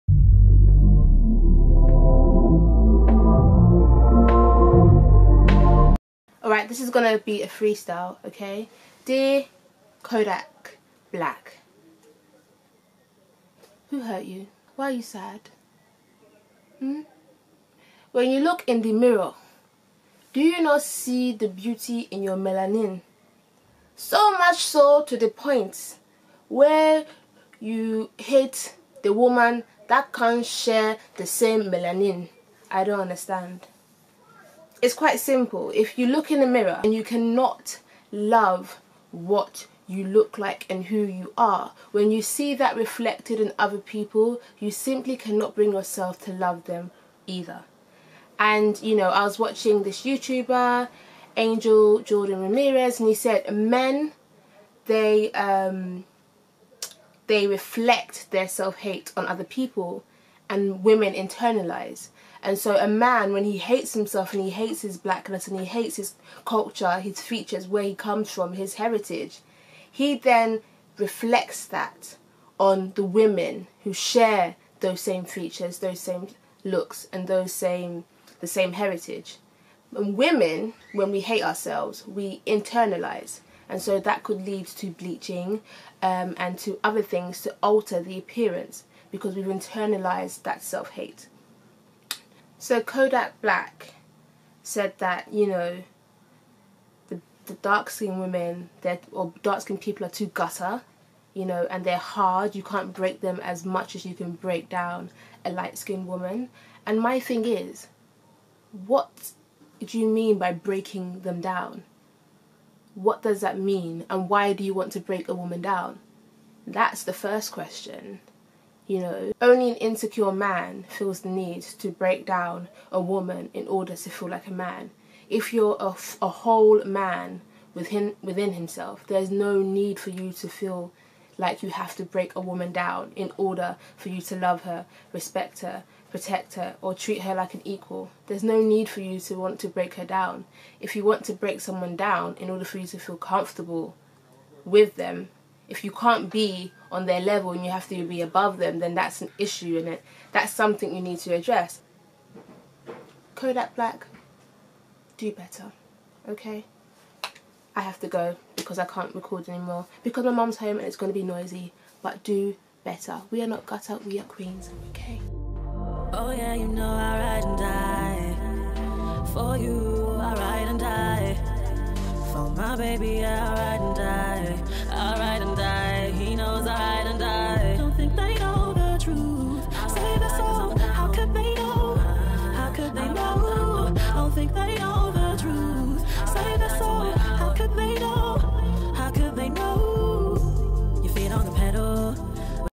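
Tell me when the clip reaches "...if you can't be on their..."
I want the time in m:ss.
2:25.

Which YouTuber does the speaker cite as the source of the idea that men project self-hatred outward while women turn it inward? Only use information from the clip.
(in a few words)
Angel Jordan Ramirez.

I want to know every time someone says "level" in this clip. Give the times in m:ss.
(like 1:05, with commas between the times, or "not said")
2:27.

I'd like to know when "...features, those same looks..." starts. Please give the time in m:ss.
1:15.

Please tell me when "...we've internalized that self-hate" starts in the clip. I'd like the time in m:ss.
1:29.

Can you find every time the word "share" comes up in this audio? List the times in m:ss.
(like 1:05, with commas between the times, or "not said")
0:30, 1:13.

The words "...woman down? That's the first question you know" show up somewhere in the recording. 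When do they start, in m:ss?
1:55.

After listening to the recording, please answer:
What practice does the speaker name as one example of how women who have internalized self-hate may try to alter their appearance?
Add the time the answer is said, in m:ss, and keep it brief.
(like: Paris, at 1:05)
Bleaching, at 1:24.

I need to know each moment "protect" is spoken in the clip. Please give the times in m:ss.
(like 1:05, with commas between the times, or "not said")
2:16.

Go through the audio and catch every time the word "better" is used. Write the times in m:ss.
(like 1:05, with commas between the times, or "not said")
2:35, 2:42.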